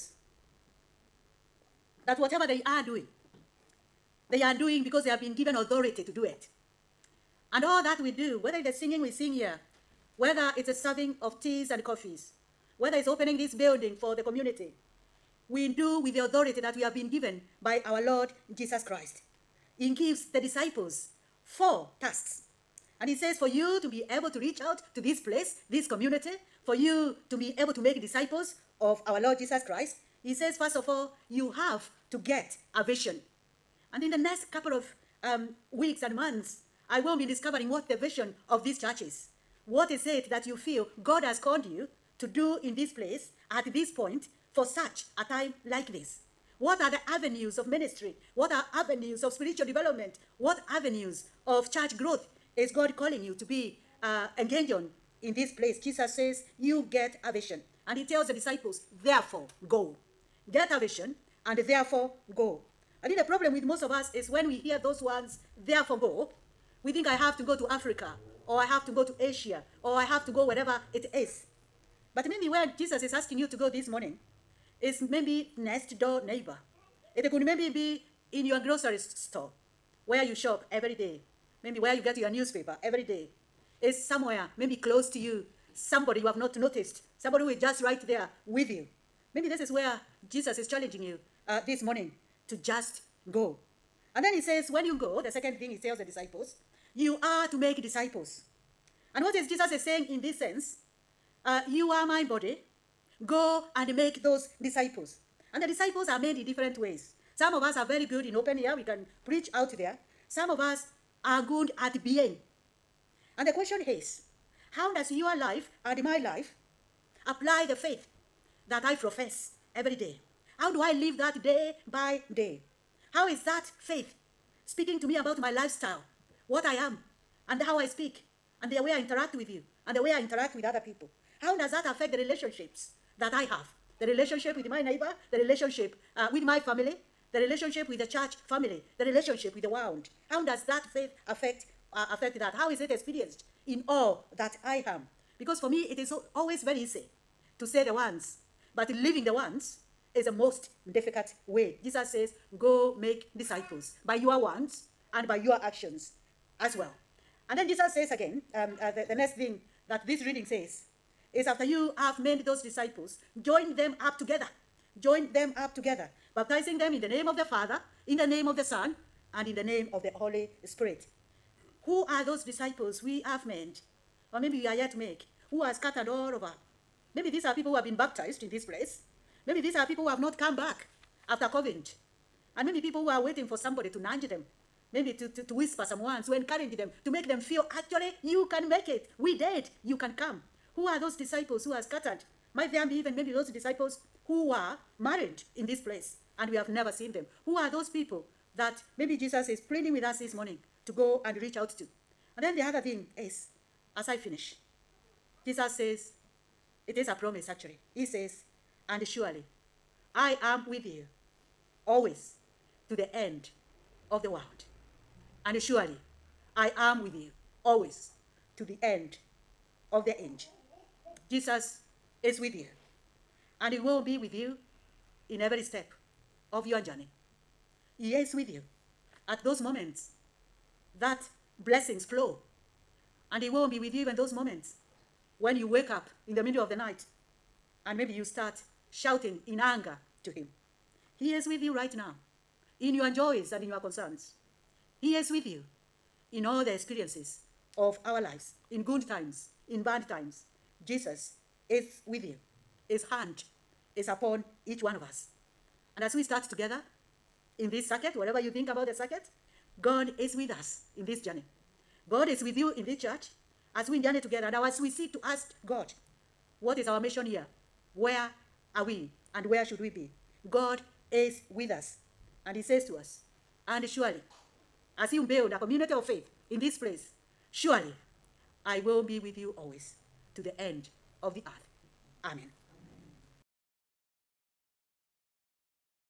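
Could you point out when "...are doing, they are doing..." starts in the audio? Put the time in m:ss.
0:02.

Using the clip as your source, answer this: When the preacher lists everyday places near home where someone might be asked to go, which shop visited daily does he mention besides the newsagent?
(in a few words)
grocery store.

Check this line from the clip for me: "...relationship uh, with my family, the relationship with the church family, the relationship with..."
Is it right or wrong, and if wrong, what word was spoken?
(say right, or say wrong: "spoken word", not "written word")
right.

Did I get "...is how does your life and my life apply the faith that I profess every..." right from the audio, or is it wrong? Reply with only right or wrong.
right.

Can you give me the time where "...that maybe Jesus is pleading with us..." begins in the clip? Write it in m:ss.
3:18.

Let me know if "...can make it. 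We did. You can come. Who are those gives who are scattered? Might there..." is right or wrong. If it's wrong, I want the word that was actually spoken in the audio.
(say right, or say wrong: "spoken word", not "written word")
wrong: "disciples", not "gives".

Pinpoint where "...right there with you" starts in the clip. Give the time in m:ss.
1:27.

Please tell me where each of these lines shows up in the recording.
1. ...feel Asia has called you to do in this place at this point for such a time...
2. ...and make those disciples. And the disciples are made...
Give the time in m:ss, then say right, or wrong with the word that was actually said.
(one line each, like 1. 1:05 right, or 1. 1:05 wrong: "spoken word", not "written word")
1. 0:40 wrong: "God", not "Asia"
2. 1:43 right.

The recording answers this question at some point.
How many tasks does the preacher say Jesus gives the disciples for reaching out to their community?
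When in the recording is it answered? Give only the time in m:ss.
0:21.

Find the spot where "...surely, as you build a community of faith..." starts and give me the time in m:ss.
4:33.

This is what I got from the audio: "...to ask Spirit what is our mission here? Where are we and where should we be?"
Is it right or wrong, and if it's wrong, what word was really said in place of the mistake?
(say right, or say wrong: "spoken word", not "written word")
wrong: "God", not "Spirit".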